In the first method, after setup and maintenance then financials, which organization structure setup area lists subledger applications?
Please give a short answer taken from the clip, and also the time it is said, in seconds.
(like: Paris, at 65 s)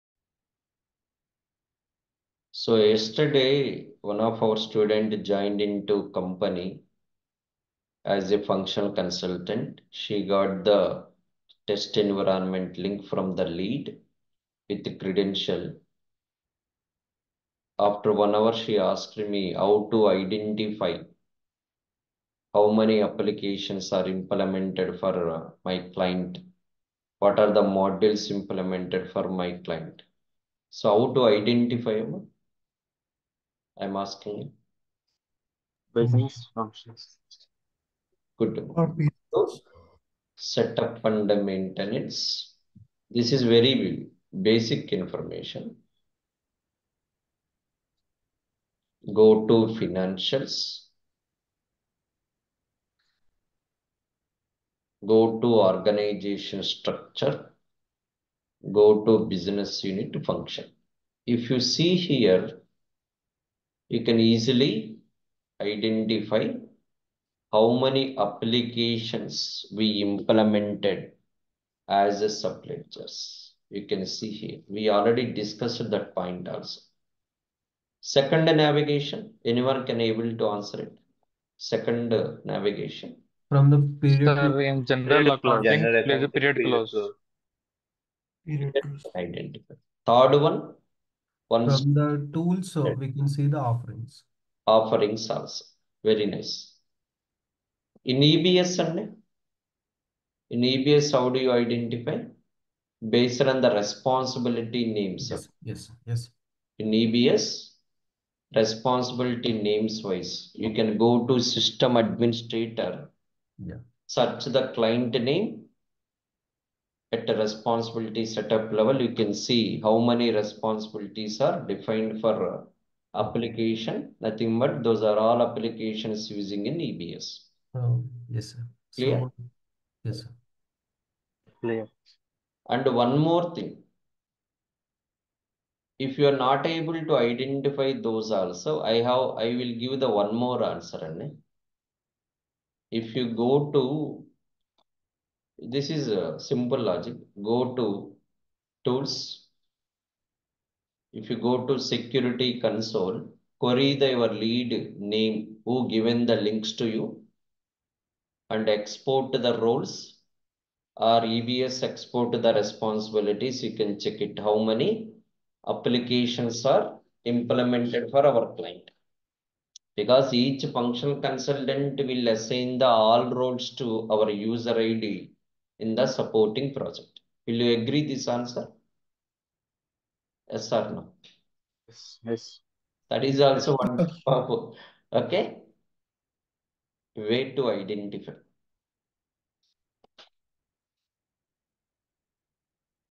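Business unit function, at 59 s.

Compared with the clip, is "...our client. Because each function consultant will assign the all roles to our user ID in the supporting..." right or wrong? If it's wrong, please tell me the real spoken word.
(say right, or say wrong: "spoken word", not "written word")
right.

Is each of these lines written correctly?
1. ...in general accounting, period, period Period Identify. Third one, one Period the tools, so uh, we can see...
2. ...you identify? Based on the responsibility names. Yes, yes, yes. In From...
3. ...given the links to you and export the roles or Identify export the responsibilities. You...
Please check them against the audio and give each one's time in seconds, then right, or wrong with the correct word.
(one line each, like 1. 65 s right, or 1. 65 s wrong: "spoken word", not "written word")
1. 84 s wrong: "From", not "Period"
2. 101 s wrong: "EBS", not "From"
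3. 155 s wrong: "EBS", not "Identify".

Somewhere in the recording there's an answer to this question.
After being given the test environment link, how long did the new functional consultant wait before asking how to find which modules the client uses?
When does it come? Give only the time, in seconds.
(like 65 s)
18 s.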